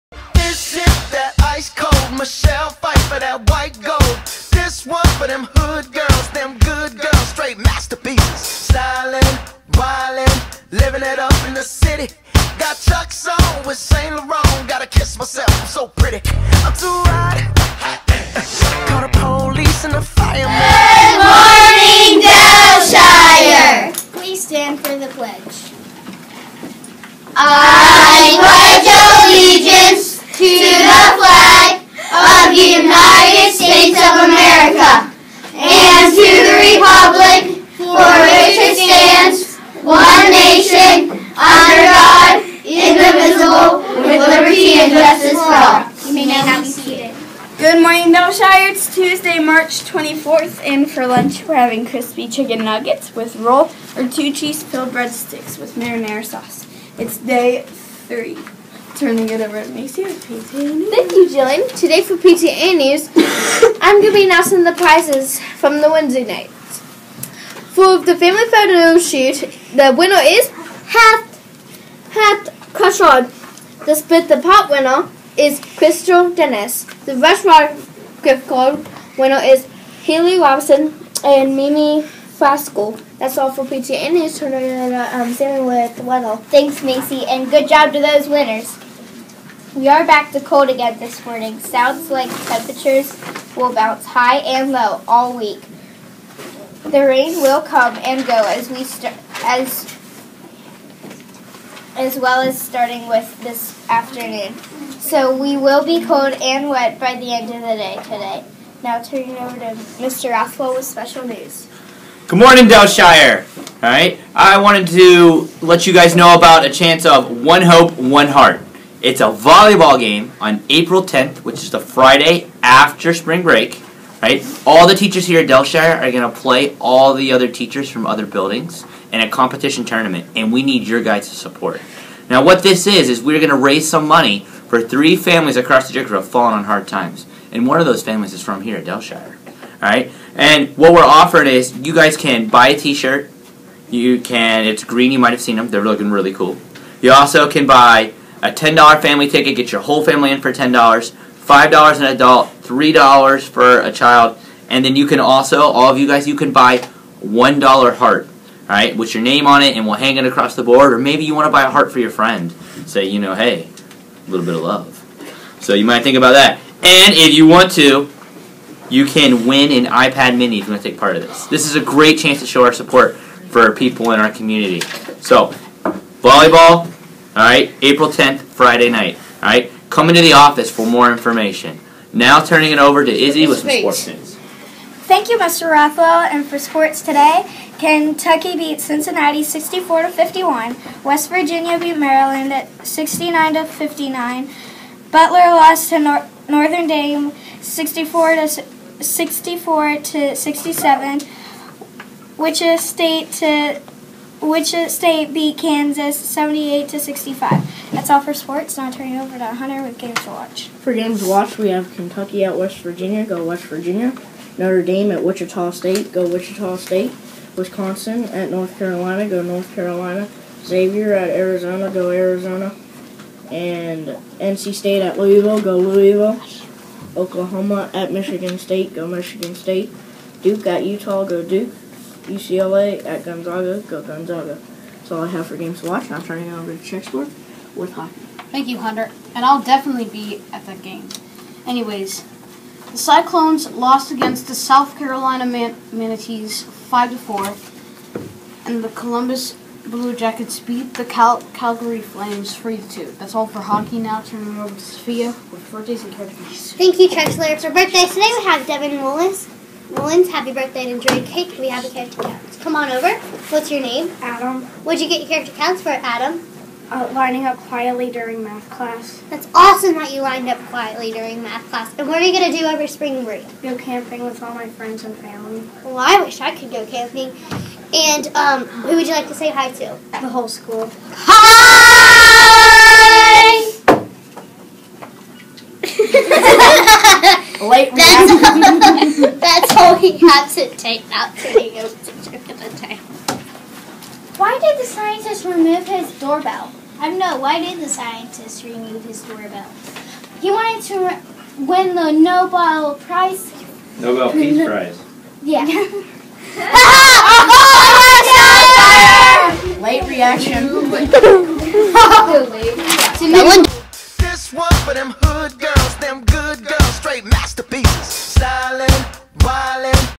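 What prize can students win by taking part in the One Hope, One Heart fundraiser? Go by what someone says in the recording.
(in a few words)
iPad mini.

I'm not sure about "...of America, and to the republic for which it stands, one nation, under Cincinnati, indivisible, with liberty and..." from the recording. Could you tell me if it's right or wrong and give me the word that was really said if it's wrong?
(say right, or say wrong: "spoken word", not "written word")
wrong: "God", not "Cincinnati".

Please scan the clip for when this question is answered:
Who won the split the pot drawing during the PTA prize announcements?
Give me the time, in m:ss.
1:15.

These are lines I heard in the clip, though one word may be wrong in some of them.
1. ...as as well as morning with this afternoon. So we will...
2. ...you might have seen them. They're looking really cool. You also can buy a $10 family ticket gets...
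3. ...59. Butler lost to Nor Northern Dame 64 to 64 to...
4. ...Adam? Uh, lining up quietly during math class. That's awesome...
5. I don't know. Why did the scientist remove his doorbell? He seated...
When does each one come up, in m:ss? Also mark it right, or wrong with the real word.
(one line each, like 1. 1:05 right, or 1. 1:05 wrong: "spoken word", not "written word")
1. 1:39 wrong: "starting", not "morning"
2. 2:25 right
3. 3:13 right
4. 4:25 right
5. 4:56 wrong: "wanted", not "seated".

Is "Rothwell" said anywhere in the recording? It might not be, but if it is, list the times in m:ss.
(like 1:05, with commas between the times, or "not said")
1:50, 3:05.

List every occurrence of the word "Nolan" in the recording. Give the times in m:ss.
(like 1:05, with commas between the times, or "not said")
4:19.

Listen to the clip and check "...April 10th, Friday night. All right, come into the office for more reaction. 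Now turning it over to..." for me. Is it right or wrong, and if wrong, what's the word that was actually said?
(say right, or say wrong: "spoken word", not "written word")
wrong: "information", not "reaction".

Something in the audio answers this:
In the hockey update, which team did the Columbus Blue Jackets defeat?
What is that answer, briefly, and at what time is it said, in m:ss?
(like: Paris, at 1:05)
Calgary Flames, at 4:11.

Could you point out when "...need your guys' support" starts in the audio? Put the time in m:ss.
2:10.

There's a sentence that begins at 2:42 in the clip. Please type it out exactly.
Say, you know, hey, a little bit of love.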